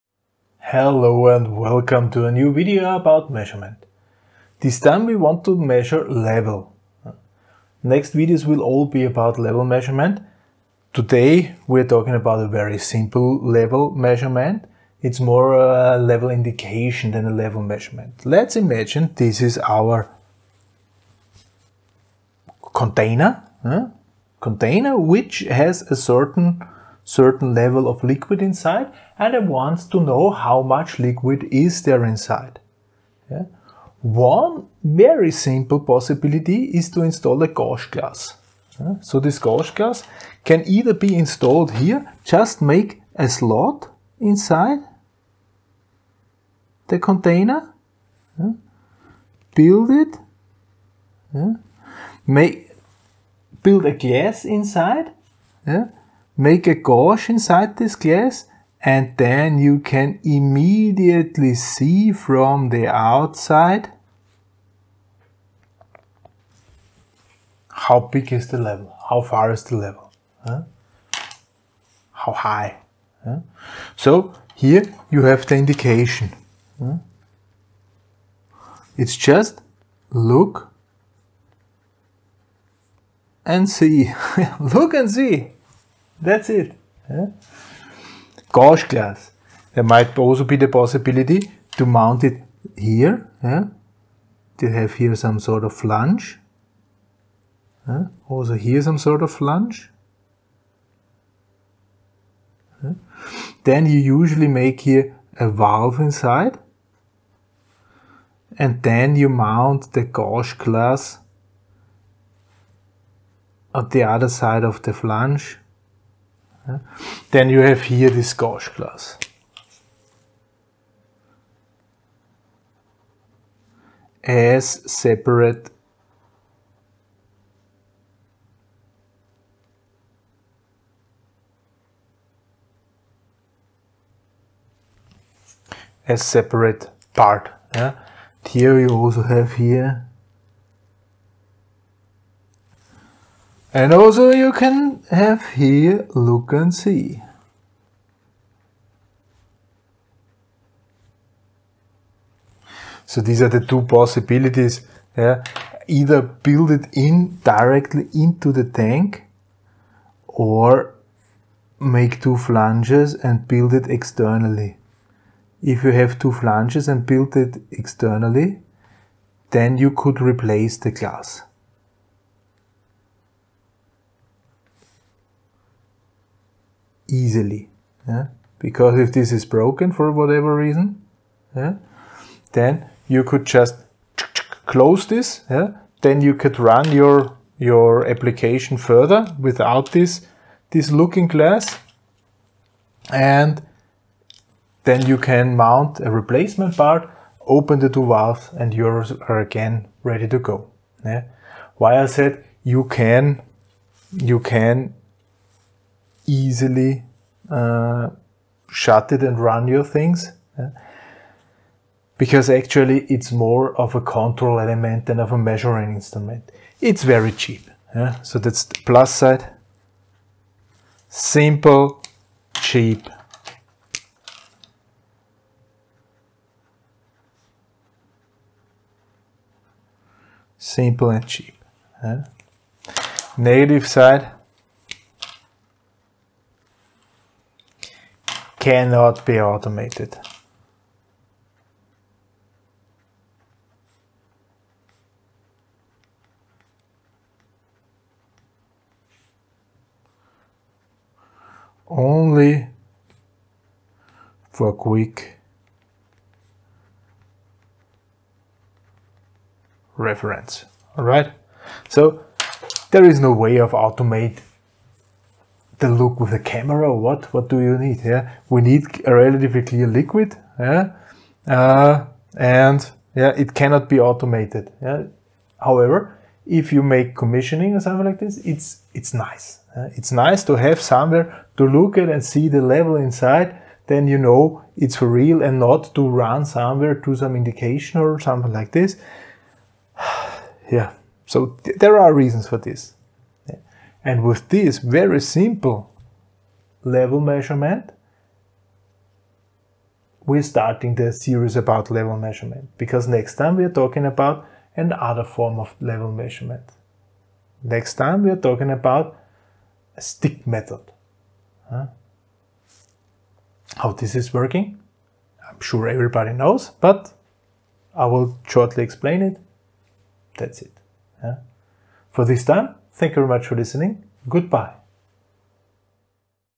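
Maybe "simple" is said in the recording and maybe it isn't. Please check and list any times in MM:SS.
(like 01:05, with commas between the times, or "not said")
00:12, 00:35, 03:41, 03:50, 04:55.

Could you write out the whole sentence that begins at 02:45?
If you have two flanges and build it externally, then you could replace the glass.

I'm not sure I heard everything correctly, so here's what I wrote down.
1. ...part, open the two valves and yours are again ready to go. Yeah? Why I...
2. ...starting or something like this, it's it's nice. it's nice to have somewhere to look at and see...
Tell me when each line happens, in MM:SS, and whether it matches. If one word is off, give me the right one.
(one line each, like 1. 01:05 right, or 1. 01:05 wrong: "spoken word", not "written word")
1. 03:16 right
2. 04:37 wrong: "commissioning", not "starting".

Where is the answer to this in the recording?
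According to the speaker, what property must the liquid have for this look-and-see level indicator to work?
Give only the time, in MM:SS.
04:29.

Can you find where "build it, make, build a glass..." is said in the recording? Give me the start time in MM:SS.
00:49.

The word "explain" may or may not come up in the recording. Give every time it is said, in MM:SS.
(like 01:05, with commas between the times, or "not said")
05:18.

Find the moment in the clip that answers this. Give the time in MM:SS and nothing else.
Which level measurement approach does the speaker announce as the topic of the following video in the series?
05:10.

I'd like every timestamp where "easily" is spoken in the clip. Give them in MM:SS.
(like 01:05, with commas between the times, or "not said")
02:57, 03:26.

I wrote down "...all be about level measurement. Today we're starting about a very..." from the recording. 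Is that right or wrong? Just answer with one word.
wrong.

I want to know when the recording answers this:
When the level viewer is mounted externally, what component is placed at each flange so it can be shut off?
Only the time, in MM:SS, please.
01:45.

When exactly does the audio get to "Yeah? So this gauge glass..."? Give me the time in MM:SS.
00:38.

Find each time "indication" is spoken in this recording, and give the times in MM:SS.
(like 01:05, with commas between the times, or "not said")
00:16, 01:15, 04:47.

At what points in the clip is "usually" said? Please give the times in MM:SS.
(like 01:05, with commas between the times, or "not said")
01:43.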